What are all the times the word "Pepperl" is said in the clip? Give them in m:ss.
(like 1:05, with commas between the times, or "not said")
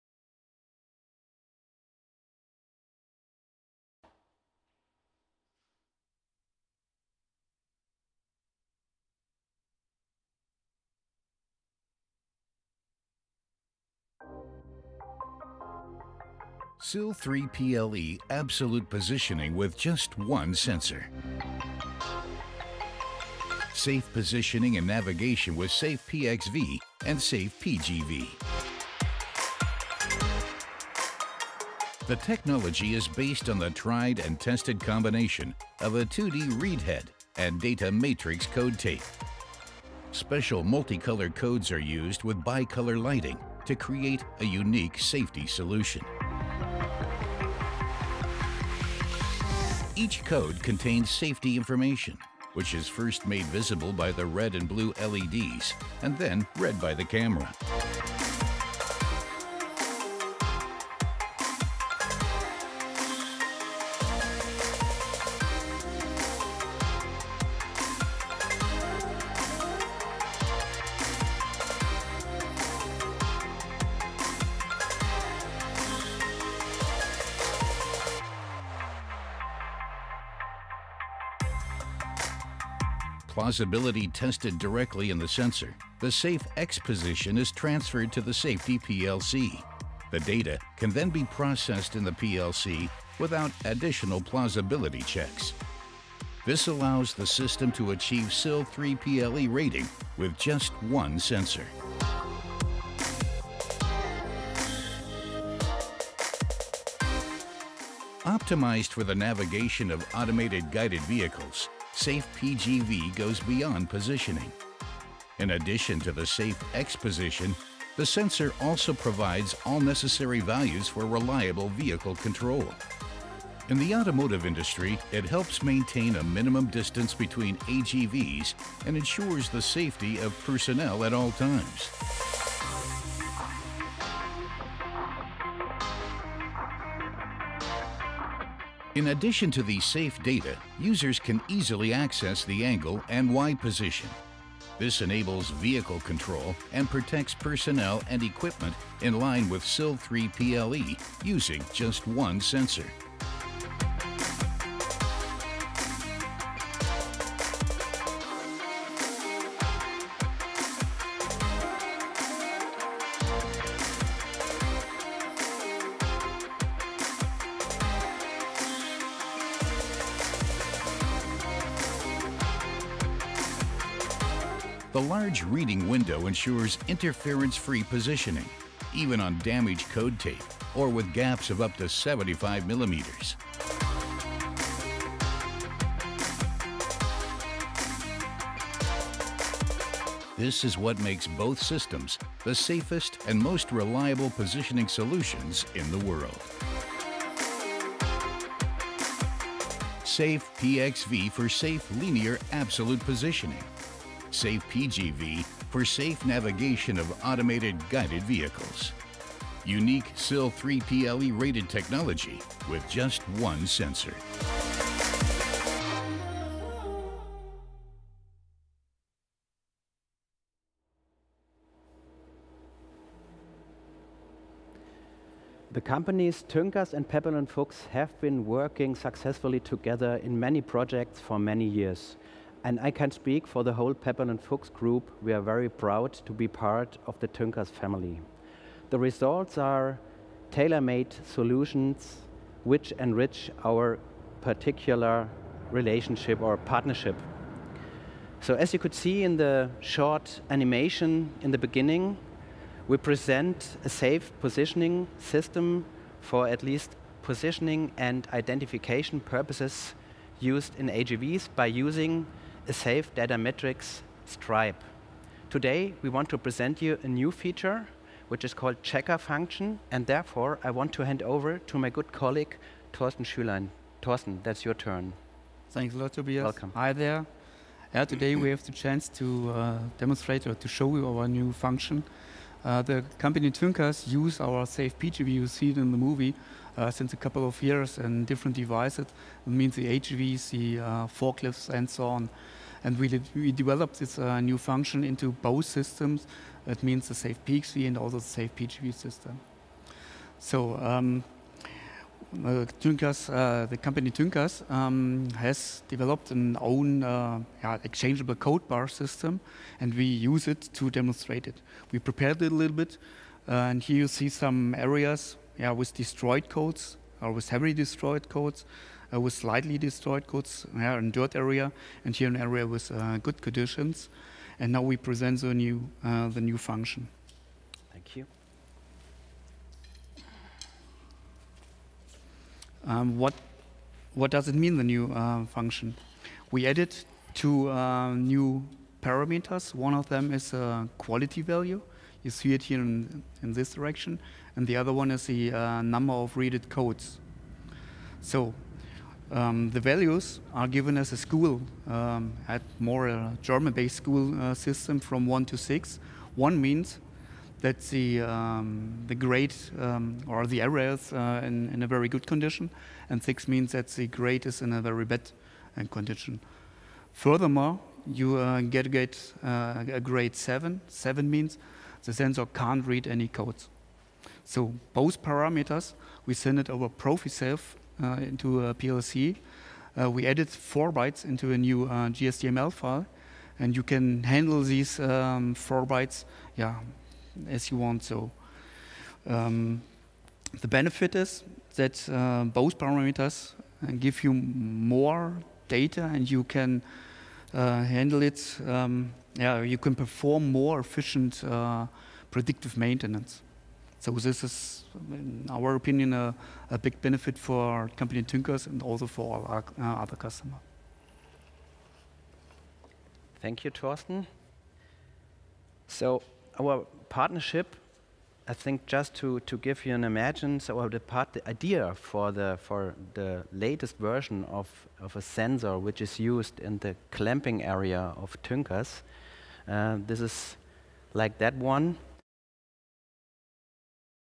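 3:47, 3:53.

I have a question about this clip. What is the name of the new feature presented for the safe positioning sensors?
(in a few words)
checker function.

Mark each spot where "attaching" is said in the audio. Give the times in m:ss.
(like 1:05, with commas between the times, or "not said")
not said.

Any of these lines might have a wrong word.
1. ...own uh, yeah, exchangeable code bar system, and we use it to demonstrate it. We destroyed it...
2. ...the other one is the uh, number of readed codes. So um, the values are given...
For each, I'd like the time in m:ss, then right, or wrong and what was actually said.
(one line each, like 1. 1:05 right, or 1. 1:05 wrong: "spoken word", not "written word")
1. 5:06 wrong: "prepared", not "destroyed"
2. 5:44 right.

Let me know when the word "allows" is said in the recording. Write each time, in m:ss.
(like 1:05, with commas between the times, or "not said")
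1:36.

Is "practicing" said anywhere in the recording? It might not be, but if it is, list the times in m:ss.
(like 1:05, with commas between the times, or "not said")
not said.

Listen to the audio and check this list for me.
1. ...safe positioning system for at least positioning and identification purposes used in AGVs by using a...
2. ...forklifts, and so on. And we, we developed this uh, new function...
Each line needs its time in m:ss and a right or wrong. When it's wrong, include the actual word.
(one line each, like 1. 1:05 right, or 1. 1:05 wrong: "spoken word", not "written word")
1. 4:13 right
2. 4:51 right.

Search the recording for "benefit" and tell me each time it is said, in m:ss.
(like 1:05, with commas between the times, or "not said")
6:30, 6:47.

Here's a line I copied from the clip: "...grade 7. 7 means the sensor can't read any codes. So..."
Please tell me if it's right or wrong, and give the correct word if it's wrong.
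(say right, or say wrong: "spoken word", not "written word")
right.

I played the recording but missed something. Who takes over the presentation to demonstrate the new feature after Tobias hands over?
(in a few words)
Thorsten Schülein.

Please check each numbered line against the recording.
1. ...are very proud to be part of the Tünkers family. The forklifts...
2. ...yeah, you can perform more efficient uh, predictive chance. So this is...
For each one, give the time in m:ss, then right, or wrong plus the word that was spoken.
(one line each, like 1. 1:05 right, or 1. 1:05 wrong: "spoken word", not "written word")
1. 3:55 wrong: "results", not "forklifts"
2. 6:39 wrong: "maintenance", not "chance".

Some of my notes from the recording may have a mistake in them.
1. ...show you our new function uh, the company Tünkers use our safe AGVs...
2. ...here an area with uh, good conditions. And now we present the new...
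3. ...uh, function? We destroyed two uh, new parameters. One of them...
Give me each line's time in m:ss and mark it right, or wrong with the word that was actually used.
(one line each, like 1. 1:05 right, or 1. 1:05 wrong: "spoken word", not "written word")
1. 4:40 wrong: "PGV", not "AGVs"
2. 5:22 right
3. 5:35 wrong: "added", not "destroyed".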